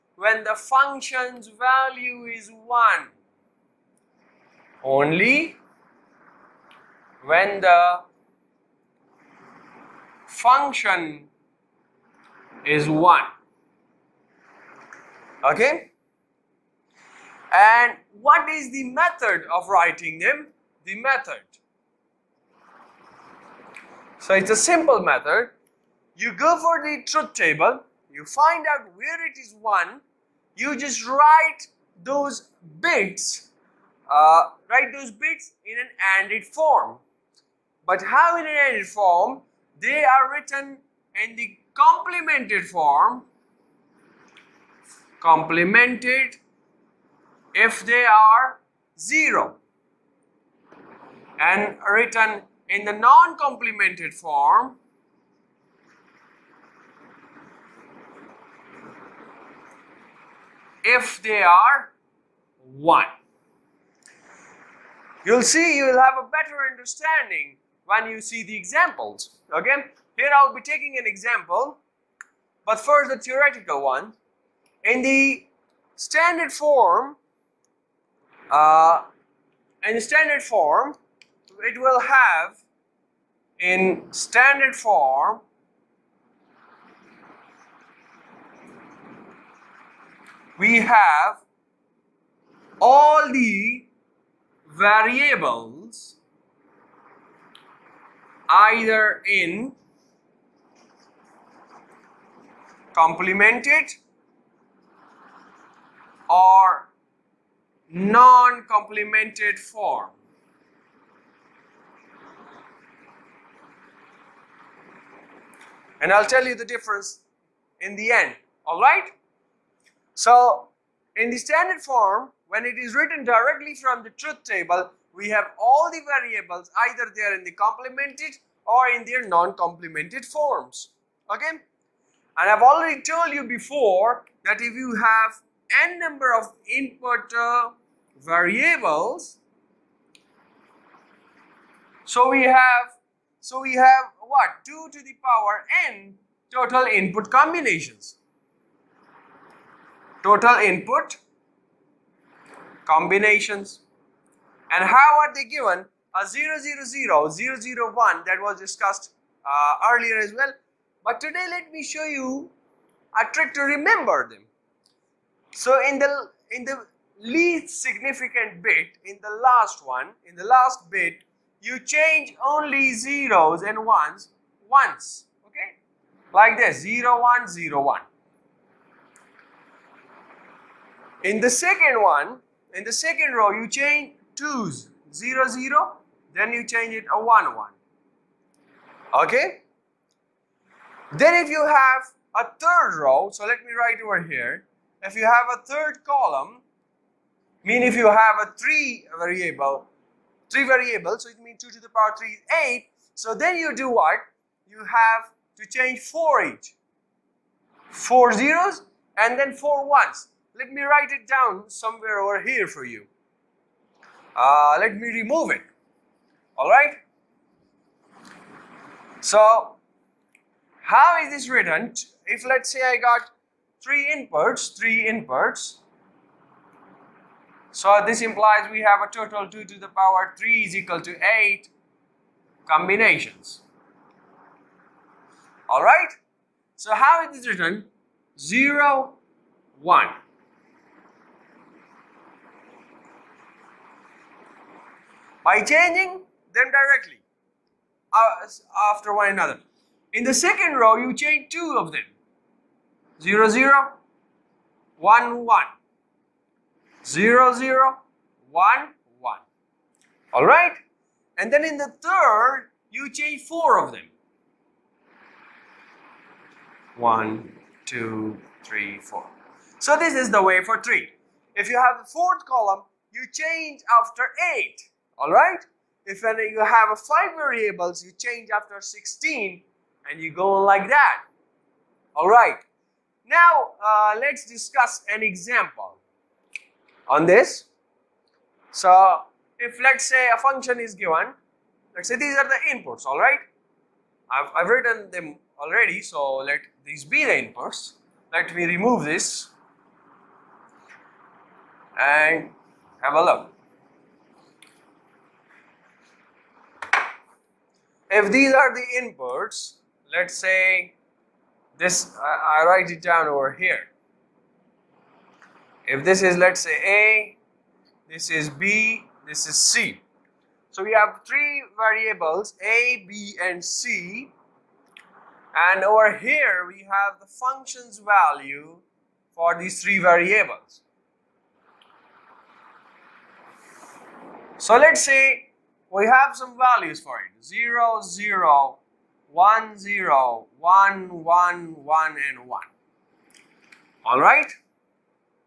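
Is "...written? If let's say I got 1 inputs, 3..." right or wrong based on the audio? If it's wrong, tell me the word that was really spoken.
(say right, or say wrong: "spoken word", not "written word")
wrong: "3", not "1".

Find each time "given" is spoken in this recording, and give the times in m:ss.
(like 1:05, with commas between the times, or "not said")
2:35, 4:50.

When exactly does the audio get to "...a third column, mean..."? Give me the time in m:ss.
3:15.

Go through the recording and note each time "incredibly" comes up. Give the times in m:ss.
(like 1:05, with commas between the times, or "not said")
not said.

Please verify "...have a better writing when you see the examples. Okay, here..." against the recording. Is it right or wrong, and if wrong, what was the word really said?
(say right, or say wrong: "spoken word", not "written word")
wrong: "understanding", not "writing".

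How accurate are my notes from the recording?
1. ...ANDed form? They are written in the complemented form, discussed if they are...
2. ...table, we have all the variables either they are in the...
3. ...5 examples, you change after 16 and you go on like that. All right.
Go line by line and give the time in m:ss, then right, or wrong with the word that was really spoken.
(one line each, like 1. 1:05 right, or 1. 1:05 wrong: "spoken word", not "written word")
1. 0:38 wrong: "complemented", not "discussed"
2. 2:04 right
3. 4:36 wrong: "variables", not "examples".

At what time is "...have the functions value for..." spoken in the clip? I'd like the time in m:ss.
5:26.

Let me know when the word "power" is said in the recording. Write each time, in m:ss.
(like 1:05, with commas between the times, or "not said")
2:25, 3:21, 3:49.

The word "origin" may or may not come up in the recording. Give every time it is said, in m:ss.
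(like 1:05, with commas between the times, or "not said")
not said.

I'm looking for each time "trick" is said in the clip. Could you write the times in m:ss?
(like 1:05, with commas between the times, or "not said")
2:43.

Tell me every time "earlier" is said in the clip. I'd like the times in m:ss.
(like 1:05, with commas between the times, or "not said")
2:39.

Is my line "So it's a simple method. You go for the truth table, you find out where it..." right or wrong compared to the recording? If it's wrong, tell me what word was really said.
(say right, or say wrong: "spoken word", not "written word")
right.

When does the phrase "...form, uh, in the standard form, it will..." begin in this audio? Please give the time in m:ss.
1:16.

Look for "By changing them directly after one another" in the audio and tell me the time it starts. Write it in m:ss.
4:05.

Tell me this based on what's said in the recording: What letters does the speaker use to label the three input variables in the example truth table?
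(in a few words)
A, B and C.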